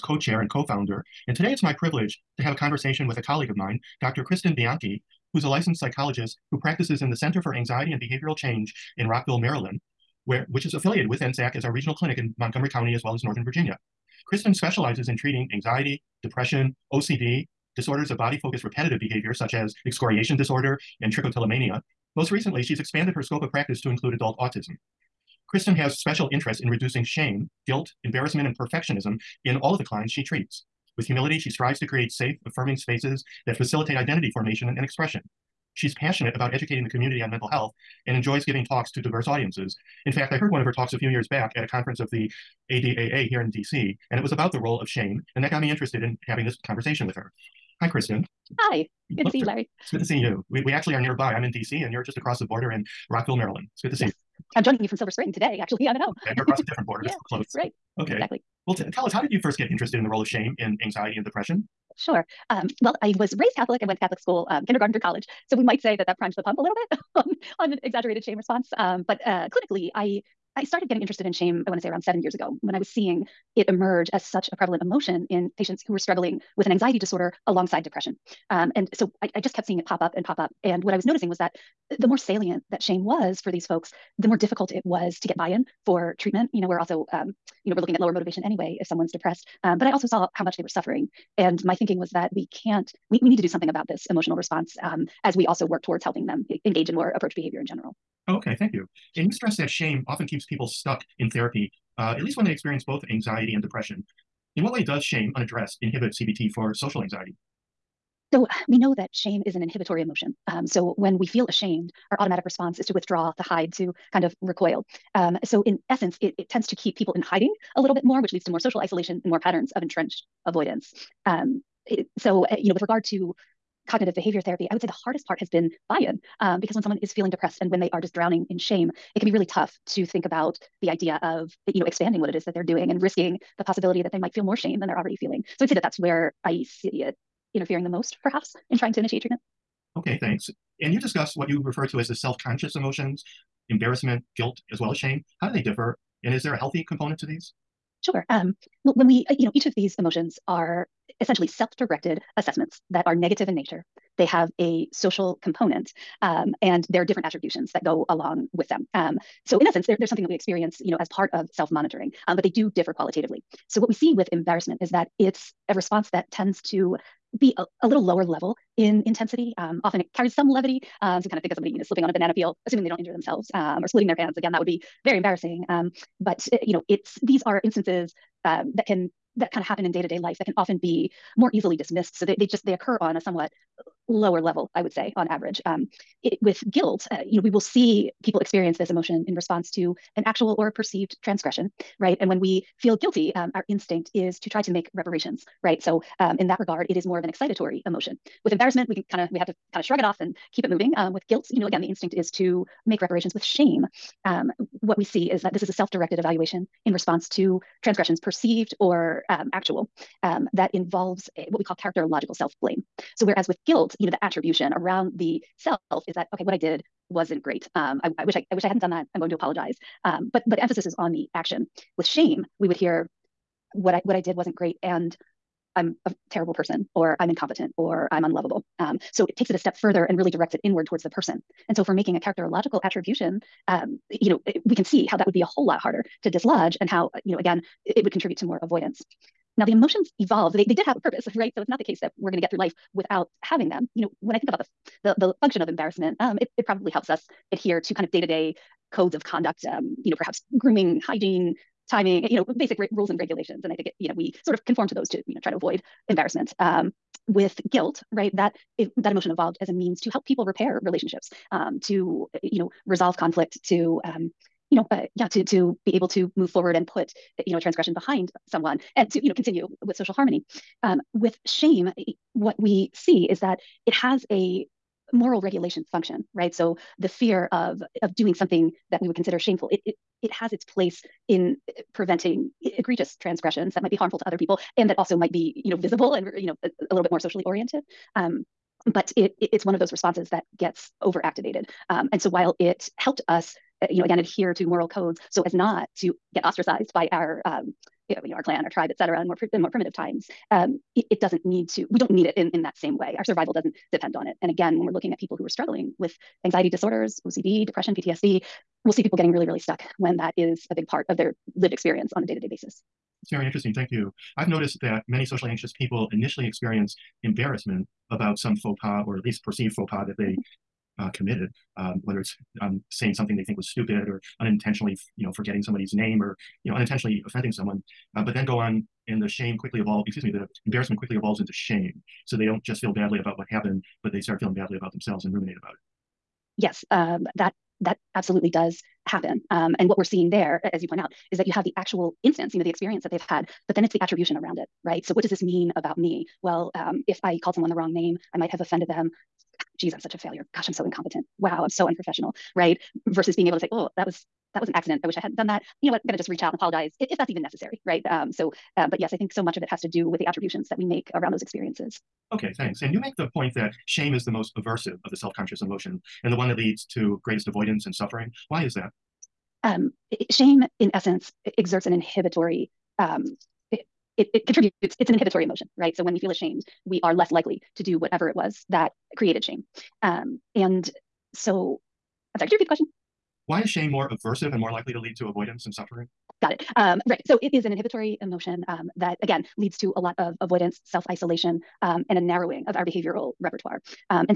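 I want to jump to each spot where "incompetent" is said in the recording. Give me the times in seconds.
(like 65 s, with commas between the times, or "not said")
227 s, 350 s.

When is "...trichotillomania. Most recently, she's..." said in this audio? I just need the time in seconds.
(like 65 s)
21 s.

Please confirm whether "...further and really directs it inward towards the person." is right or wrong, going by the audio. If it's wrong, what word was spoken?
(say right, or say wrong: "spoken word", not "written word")
right.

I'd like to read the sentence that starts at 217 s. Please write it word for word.
Um, I, I wish I, I wish I hadn't done that.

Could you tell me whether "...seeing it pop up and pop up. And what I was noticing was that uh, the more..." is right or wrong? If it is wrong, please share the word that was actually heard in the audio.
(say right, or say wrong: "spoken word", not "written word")
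right.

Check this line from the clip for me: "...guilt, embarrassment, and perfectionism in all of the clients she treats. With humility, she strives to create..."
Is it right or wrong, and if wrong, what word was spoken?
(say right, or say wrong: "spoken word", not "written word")
right.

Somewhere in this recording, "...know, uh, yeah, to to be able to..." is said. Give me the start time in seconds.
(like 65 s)
264 s.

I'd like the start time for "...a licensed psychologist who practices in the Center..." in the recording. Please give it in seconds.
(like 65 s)
5 s.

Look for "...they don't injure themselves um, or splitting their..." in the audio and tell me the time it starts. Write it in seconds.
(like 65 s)
172 s.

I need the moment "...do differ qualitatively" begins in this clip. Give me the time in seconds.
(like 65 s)
162 s.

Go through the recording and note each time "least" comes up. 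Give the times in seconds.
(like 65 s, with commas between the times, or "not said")
102 s, 319 s.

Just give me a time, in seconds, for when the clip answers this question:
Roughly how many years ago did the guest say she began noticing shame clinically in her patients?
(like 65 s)
72 s.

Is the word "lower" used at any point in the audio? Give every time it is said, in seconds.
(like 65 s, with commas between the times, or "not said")
87 s, 168 s, 184 s.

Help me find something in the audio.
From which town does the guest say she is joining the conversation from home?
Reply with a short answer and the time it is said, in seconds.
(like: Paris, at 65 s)
Silver Spring, at 54 s.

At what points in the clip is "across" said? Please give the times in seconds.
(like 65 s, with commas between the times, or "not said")
52 s, 56 s.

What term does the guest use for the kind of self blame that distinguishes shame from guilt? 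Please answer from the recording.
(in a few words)
characterological self blame.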